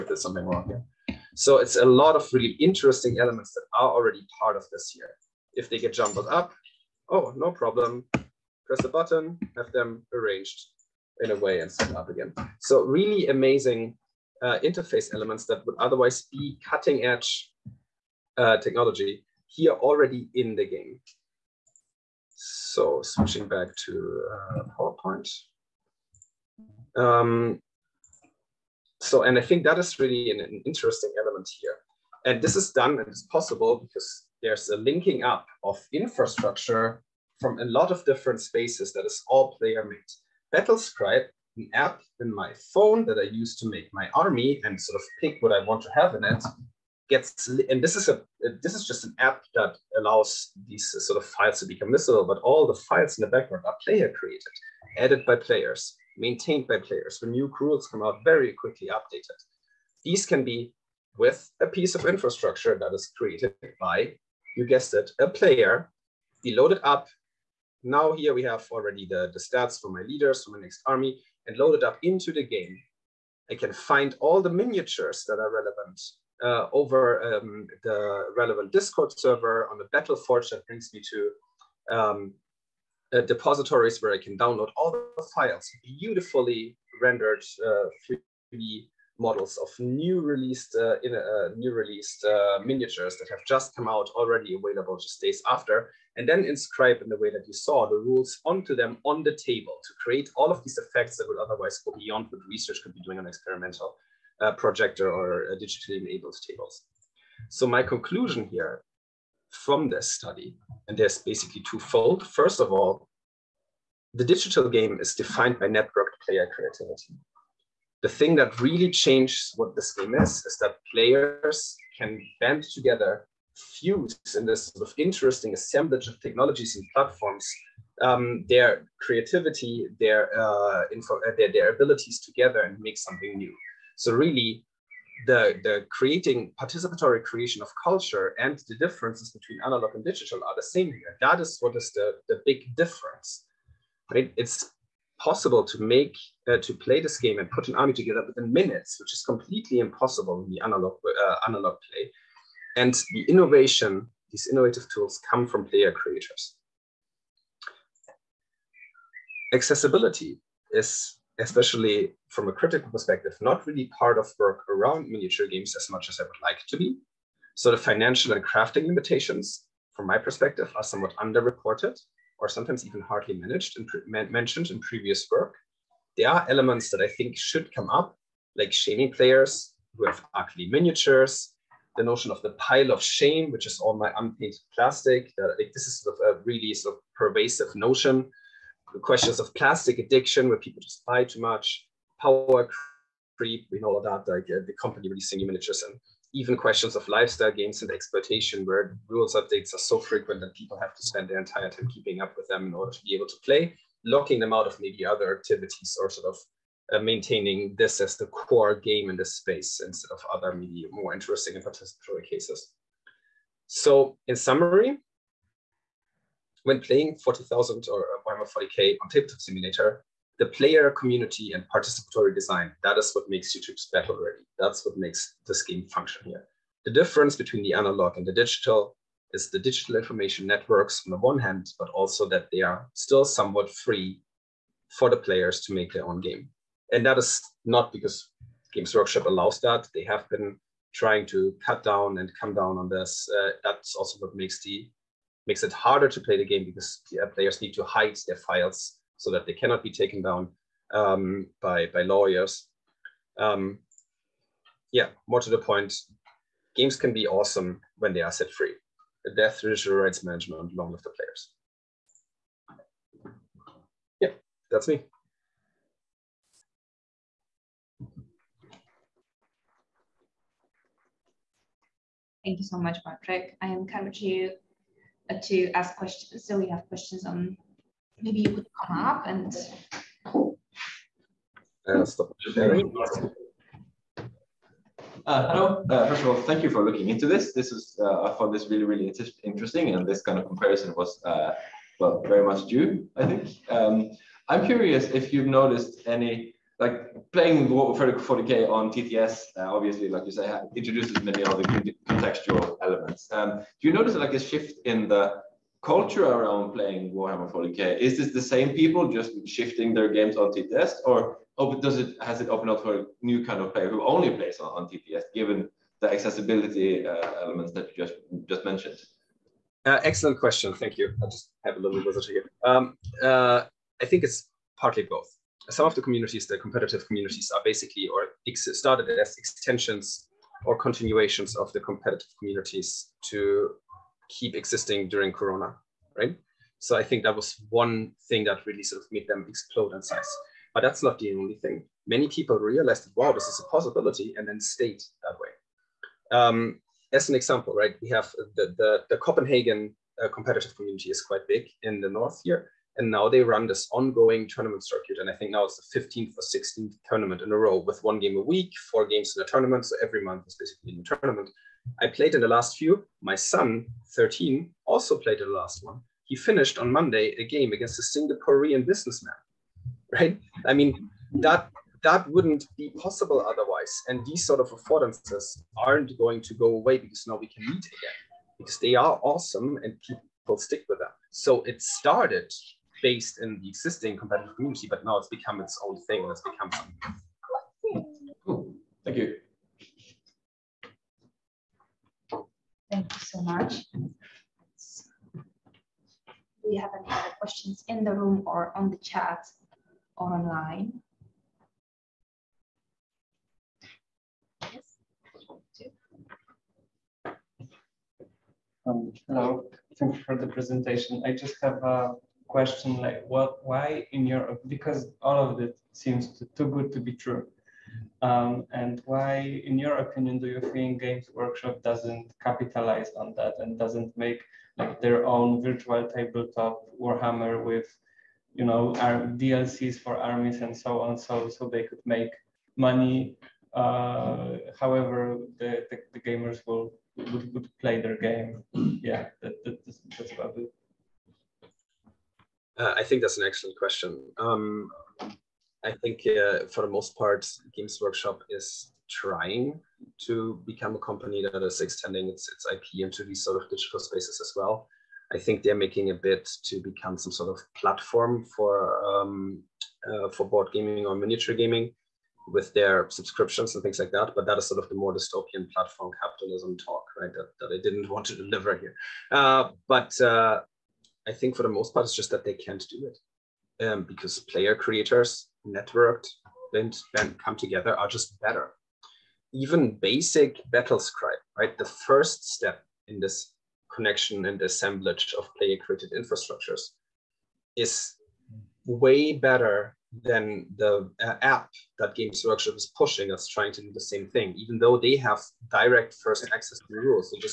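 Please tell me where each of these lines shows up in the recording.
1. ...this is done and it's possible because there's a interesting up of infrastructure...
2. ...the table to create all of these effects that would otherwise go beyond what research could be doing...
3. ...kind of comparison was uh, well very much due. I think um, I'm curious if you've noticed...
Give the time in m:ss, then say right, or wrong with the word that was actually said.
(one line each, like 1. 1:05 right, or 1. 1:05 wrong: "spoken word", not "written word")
1. 0:32 wrong: "linking", not "interesting"
2. 1:39 right
3. 4:50 right.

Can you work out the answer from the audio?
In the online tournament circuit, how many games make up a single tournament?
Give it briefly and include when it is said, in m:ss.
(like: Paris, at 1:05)
4, at 5:58.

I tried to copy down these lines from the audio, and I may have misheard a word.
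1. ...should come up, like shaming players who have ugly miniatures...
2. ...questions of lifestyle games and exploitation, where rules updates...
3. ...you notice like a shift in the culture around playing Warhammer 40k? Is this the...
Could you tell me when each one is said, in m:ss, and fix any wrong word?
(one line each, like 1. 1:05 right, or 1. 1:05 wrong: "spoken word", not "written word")
1. 2:57 right
2. 3:16 right
3. 5:03 right.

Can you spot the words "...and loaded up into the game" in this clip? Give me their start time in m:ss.
1:11.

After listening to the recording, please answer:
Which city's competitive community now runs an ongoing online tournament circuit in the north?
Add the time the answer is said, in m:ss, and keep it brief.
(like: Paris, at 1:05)
Copenhagen, at 5:49.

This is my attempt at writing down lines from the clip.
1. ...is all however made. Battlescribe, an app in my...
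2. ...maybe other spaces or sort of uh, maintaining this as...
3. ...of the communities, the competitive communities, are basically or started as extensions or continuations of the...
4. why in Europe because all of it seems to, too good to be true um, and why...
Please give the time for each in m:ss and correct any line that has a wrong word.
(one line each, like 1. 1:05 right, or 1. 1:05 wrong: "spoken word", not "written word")
1. 0:39 wrong: "player", not "however"
2. 3:24 wrong: "activities", not "spaces"
3. 5:25 right
4. 6:53 right.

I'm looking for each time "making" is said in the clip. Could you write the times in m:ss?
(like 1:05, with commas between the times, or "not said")
7:35.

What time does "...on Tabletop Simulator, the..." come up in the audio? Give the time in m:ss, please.
3:39.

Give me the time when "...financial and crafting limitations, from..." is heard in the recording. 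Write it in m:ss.
2:47.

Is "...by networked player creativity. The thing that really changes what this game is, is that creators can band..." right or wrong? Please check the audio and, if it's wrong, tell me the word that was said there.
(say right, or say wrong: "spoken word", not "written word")
wrong: "players", not "creators".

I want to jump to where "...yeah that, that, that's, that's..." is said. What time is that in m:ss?
7:19.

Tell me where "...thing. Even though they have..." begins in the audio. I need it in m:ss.
8:14.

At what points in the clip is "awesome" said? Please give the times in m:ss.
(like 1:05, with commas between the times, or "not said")
4:17, 6:19.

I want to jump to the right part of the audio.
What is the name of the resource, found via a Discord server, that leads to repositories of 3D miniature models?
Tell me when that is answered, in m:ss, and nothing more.
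1:19.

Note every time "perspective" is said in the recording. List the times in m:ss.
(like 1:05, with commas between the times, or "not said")
2:42, 2:50.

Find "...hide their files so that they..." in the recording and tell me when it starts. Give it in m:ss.
4:07.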